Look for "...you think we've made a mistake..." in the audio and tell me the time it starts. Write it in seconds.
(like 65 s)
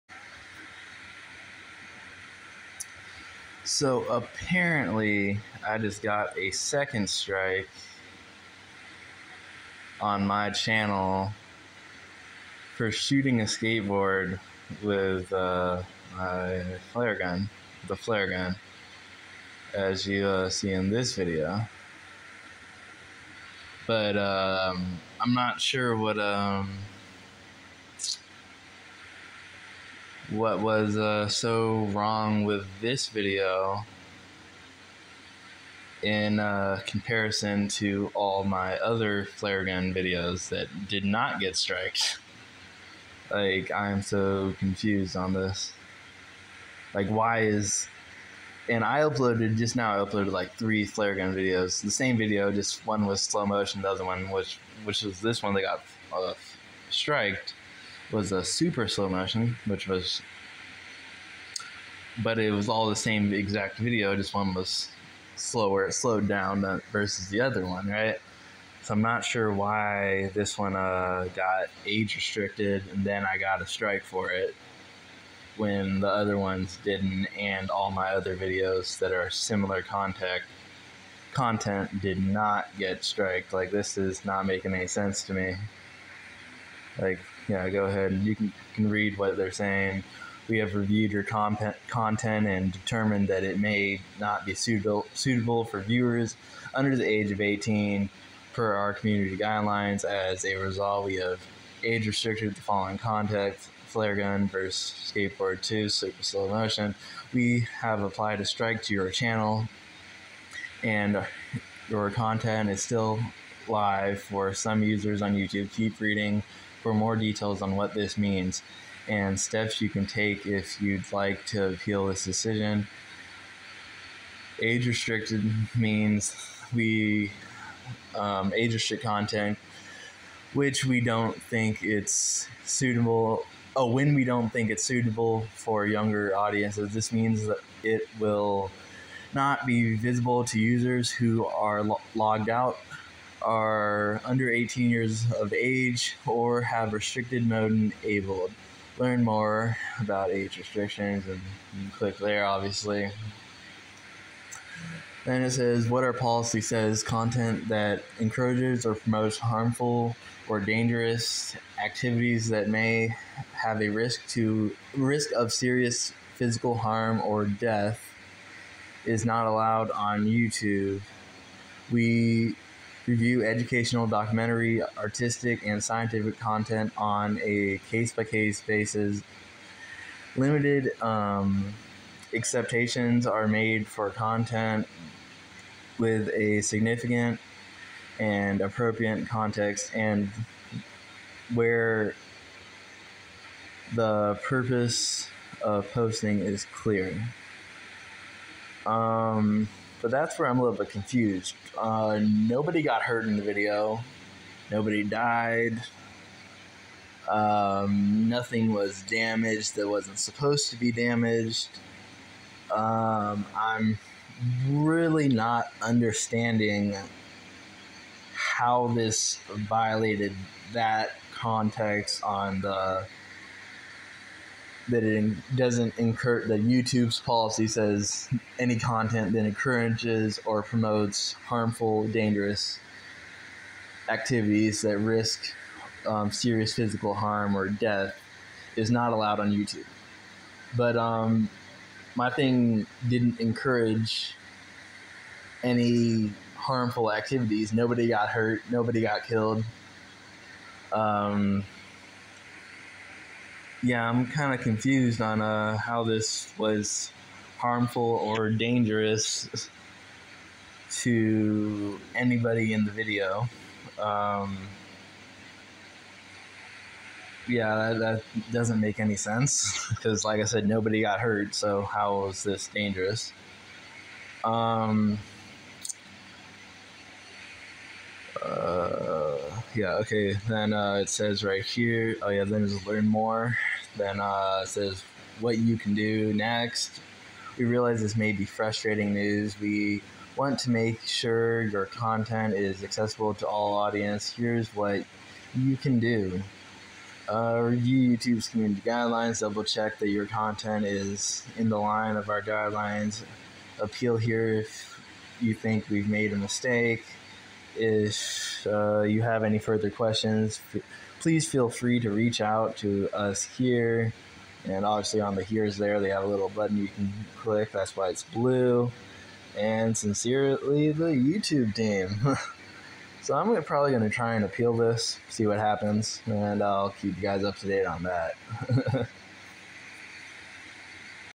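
305 s.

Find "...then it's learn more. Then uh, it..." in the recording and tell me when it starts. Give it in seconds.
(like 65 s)
282 s.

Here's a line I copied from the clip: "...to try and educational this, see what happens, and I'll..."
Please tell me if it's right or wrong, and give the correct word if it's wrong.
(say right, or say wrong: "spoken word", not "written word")
wrong: "appeal", not "educational".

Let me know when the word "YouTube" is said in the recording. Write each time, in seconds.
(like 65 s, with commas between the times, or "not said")
115 s, 170 s, 226 s, 239 s, 298 s, 321 s.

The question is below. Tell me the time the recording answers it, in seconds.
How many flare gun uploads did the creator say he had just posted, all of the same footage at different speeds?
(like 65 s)
50 s.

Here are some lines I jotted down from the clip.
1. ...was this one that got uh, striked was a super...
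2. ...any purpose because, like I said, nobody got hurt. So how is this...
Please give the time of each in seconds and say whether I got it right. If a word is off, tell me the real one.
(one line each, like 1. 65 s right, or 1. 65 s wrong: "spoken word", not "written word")
1. 55 s right
2. 268 s wrong: "sense", not "purpose".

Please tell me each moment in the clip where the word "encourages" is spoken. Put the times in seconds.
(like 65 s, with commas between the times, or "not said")
158 s, 229 s, 243 s.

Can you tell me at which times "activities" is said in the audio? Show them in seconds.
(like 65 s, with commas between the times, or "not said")
161 s, 234 s, 247 s.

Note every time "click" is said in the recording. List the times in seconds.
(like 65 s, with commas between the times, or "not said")
151 s, 317 s.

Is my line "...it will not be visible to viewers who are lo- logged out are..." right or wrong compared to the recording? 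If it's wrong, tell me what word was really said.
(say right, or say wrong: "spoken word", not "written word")
wrong: "users", not "viewers".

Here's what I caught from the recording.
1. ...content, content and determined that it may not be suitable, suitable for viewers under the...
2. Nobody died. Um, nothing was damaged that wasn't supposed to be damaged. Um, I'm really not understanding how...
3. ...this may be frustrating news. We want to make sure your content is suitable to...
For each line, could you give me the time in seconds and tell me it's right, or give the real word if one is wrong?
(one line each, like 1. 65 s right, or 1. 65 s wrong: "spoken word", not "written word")
1. 91 s right
2. 204 s right
3. 288 s wrong: "accessible", not "suitable".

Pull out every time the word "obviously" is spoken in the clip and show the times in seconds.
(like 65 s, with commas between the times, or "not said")
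152 s, 314 s.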